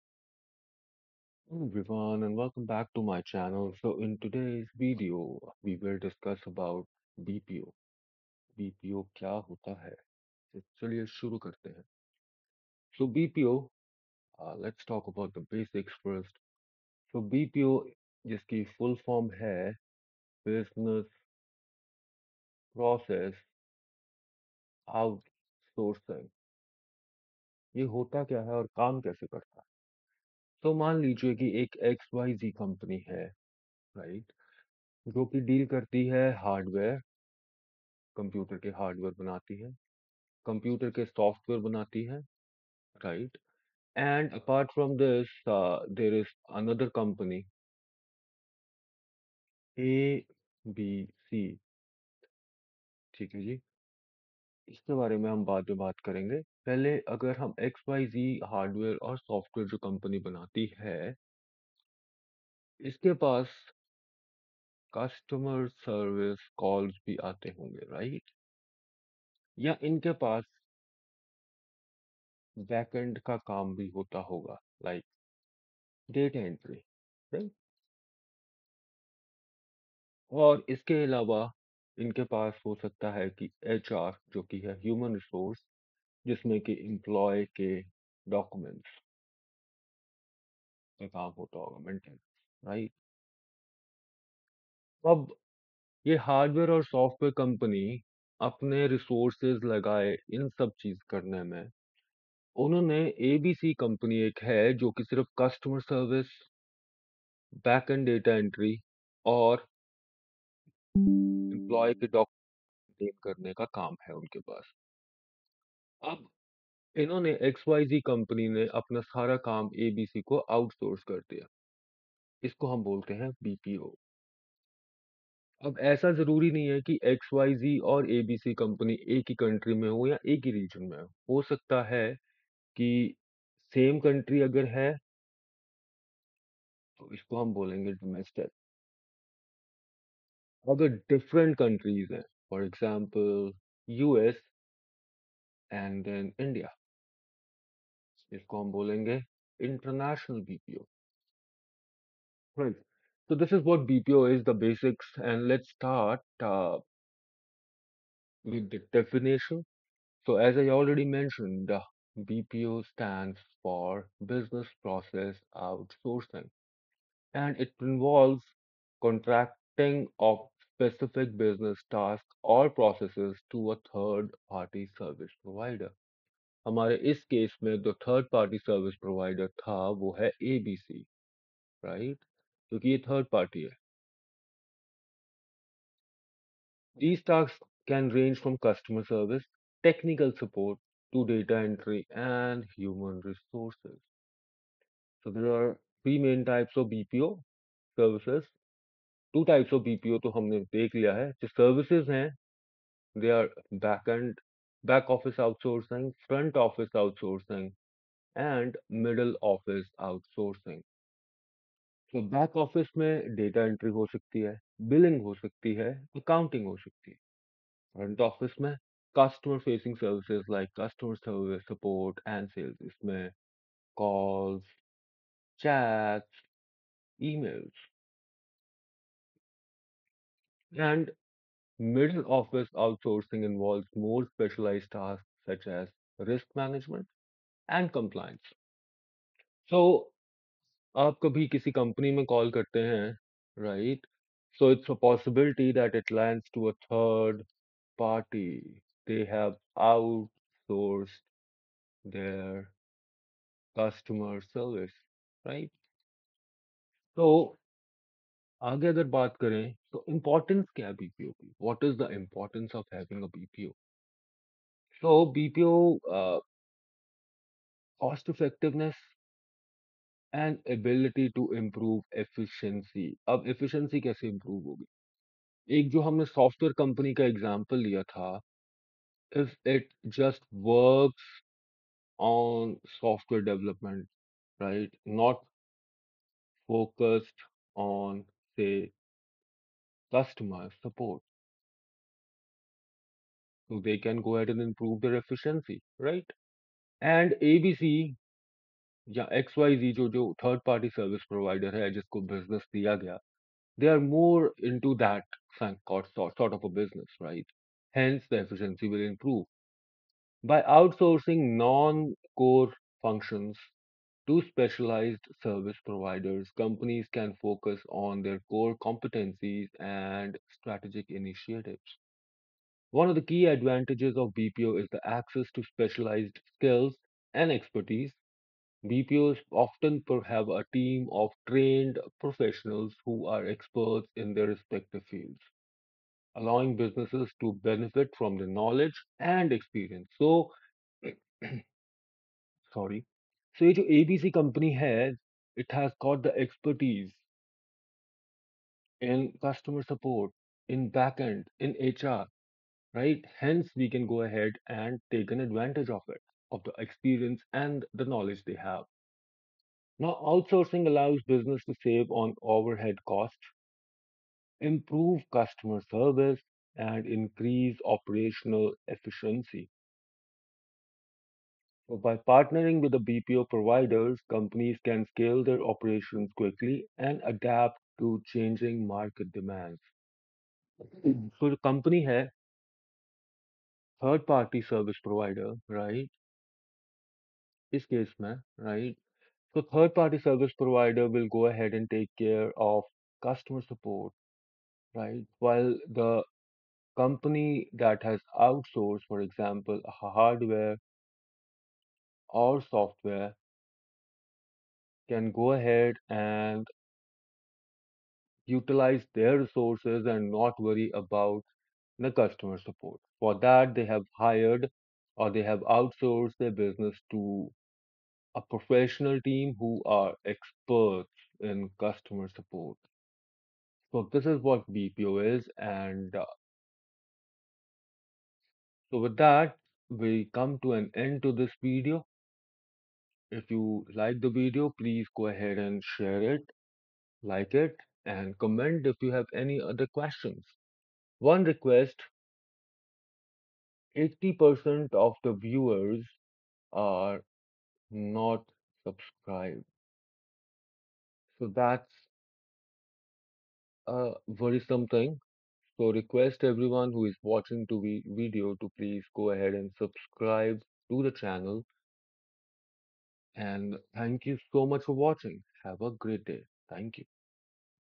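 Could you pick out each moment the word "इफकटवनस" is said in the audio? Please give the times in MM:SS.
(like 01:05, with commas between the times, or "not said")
04:28.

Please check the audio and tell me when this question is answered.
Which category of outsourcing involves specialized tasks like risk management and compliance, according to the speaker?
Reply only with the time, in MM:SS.
03:51.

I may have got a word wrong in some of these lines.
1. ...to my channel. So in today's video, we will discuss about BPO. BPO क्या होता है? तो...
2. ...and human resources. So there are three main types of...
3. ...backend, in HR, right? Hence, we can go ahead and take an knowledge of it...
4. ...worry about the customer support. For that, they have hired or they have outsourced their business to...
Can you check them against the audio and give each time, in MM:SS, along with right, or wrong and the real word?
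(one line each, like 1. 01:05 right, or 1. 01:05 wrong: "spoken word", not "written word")
1. 00:02 right
2. 03:12 right
3. 05:50 wrong: "advantage", not "knowledge"
4. 06:50 right.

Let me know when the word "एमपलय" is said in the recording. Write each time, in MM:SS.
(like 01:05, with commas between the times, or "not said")
01:26, 01:50.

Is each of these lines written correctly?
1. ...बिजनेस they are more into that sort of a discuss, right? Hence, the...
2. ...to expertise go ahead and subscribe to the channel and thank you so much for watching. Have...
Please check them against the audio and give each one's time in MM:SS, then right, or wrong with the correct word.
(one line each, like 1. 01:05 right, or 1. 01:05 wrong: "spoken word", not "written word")
1. 05:02 wrong: "business", not "discuss"
2. 07:38 wrong: "please", not "expertise".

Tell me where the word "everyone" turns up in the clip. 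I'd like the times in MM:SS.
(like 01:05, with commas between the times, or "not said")
00:01, 07:36.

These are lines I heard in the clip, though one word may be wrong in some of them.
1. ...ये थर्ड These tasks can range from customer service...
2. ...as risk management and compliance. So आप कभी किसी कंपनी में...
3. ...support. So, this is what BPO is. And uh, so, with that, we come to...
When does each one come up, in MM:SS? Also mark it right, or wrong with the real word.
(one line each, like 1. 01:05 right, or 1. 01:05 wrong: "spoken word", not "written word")
1. 03:02 right
2. 03:55 right
3. 07:02 right.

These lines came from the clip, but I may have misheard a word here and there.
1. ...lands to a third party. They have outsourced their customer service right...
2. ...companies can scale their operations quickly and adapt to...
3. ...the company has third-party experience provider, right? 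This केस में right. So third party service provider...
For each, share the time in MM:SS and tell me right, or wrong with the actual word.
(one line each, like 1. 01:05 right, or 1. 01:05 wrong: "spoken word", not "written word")
1. 04:06 right
2. 06:14 right
3. 06:21 wrong: "service", not "experience".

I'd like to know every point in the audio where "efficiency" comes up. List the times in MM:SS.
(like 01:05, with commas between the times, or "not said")
04:55, 05:08, 06:08.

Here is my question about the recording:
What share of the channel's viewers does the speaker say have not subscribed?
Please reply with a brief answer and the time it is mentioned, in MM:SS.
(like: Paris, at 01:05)
80%, at 07:23.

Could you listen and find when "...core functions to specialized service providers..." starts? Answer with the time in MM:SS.
05:12.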